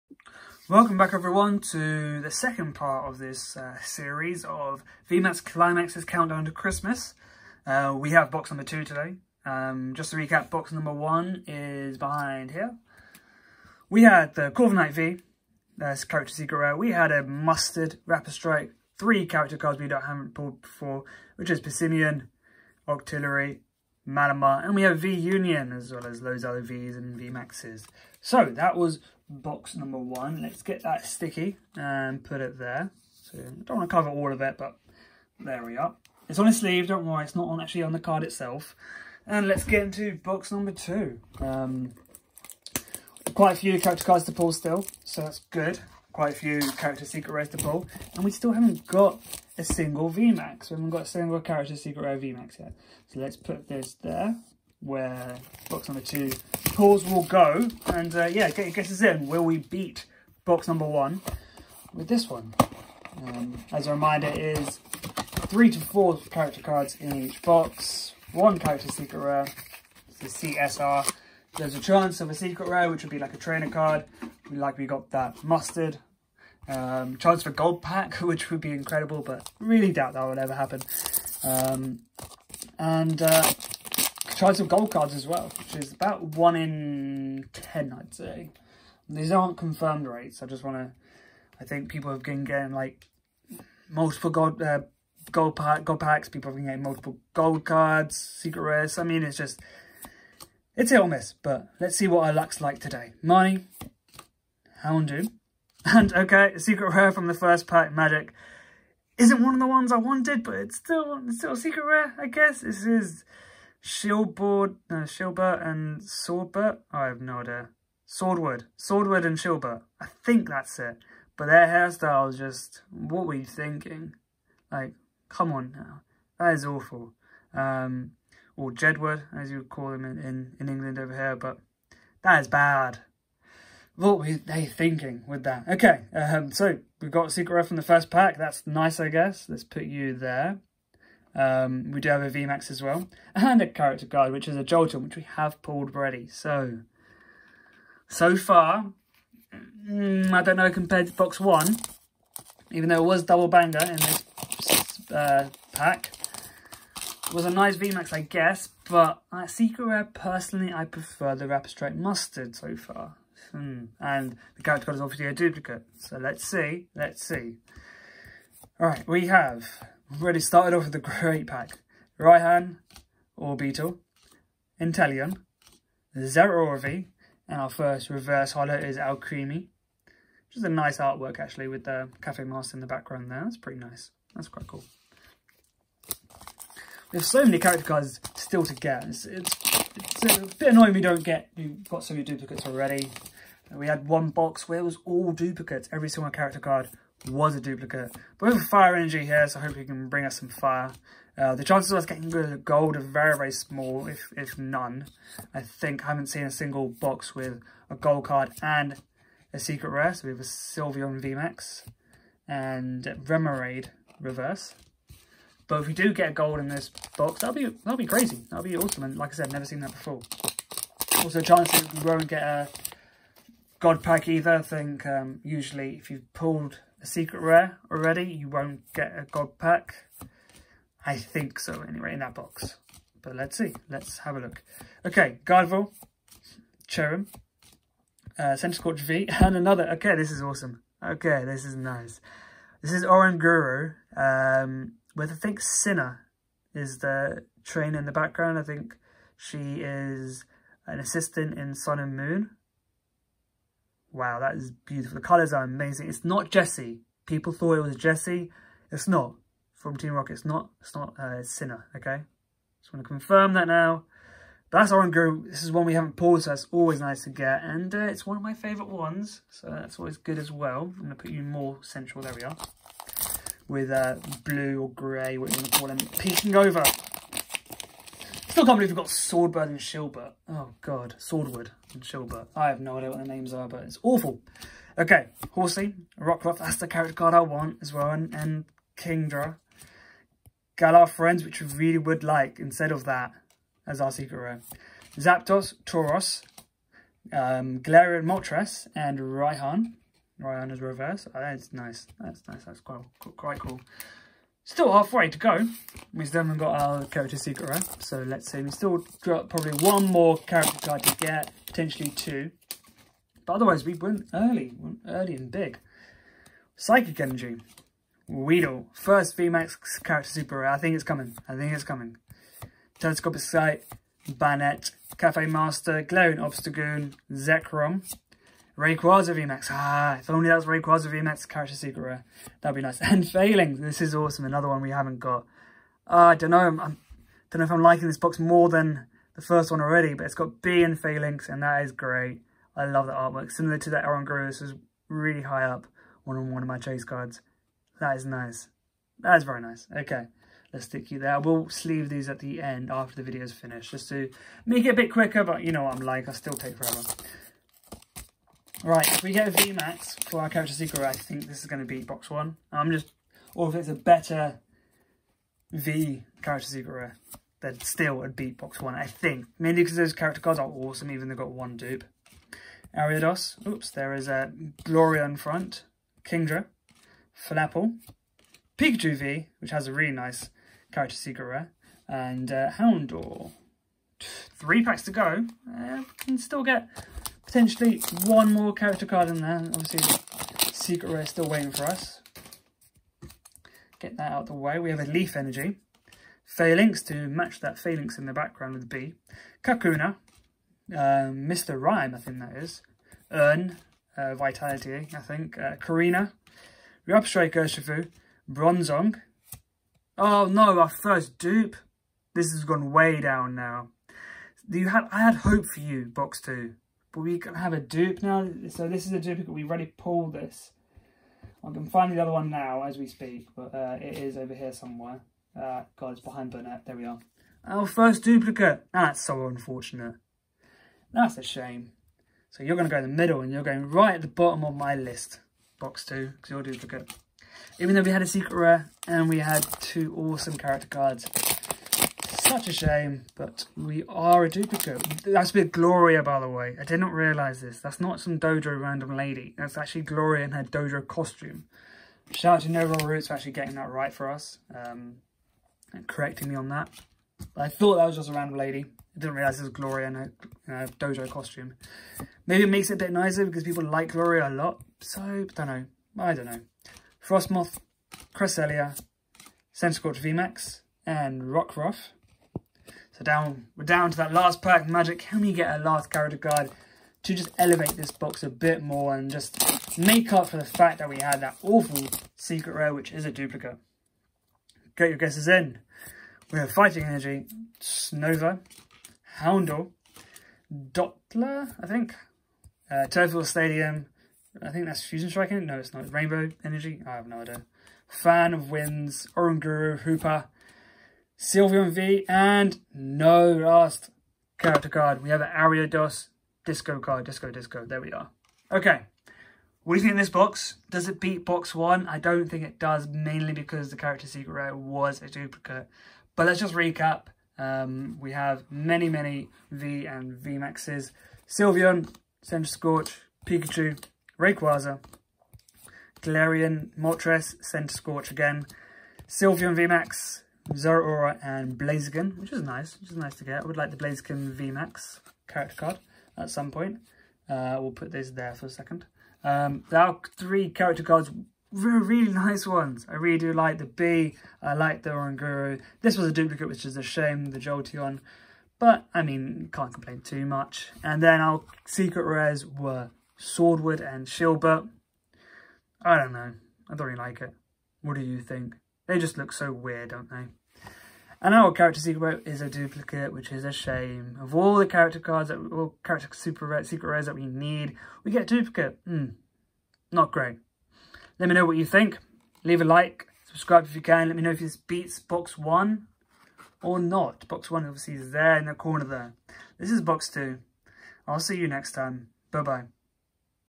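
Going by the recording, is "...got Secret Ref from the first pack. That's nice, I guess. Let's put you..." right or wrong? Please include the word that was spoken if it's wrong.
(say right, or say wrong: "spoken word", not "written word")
right.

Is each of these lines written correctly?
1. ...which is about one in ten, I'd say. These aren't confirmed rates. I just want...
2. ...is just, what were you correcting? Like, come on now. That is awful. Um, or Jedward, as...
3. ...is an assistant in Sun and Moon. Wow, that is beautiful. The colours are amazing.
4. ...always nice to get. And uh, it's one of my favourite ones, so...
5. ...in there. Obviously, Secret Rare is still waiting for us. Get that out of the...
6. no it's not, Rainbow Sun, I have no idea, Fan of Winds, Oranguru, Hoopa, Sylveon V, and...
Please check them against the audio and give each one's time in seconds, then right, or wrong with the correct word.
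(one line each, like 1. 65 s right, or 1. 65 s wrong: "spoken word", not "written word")
1. 85 s right
2. 122 s wrong: "thinking", not "correcting"
3. 249 s right
4. 266 s right
5. 389 s right
6. 495 s wrong: "Energy", not "Sun".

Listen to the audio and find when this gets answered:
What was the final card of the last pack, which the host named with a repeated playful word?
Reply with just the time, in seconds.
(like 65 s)
505 s.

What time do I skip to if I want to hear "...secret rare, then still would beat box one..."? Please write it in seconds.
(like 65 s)
366 s.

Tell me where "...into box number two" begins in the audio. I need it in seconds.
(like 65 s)
39 s.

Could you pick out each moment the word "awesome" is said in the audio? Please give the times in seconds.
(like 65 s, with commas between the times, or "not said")
218 s, 240 s, 334 s, 370 s, 440 s.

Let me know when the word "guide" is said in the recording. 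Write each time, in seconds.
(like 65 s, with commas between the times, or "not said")
144 s, 164 s.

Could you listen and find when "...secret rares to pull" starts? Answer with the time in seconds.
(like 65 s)
47 s.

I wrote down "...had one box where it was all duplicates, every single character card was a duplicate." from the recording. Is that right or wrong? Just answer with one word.
right.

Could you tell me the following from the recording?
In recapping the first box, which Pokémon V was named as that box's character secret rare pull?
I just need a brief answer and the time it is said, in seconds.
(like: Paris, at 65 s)
Corviknight V, at 14 s.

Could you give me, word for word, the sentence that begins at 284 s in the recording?
Okay, Horsea, Rockruff, that's the character card I want as well, and, and Kingdra.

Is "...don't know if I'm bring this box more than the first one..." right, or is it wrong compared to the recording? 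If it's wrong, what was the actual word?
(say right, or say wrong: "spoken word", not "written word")
wrong: "liking", not "bring".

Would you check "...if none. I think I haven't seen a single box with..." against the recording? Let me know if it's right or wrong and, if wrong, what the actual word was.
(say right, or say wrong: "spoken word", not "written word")
right.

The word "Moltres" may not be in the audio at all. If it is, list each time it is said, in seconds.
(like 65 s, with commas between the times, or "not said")
298 s, 526 s.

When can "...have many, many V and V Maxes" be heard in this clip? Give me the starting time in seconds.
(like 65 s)
518 s.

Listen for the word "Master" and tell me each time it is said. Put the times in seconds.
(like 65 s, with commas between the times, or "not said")
182 s, 325 s.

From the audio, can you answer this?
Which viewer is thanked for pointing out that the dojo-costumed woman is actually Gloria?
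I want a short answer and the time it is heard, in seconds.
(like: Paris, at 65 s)
Nova Roots, at 452 s.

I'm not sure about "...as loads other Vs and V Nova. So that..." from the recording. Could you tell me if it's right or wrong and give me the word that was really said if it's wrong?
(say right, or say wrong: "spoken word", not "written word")
wrong: "Maxes", not "Nova".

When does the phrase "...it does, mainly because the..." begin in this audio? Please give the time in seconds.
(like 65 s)
512 s.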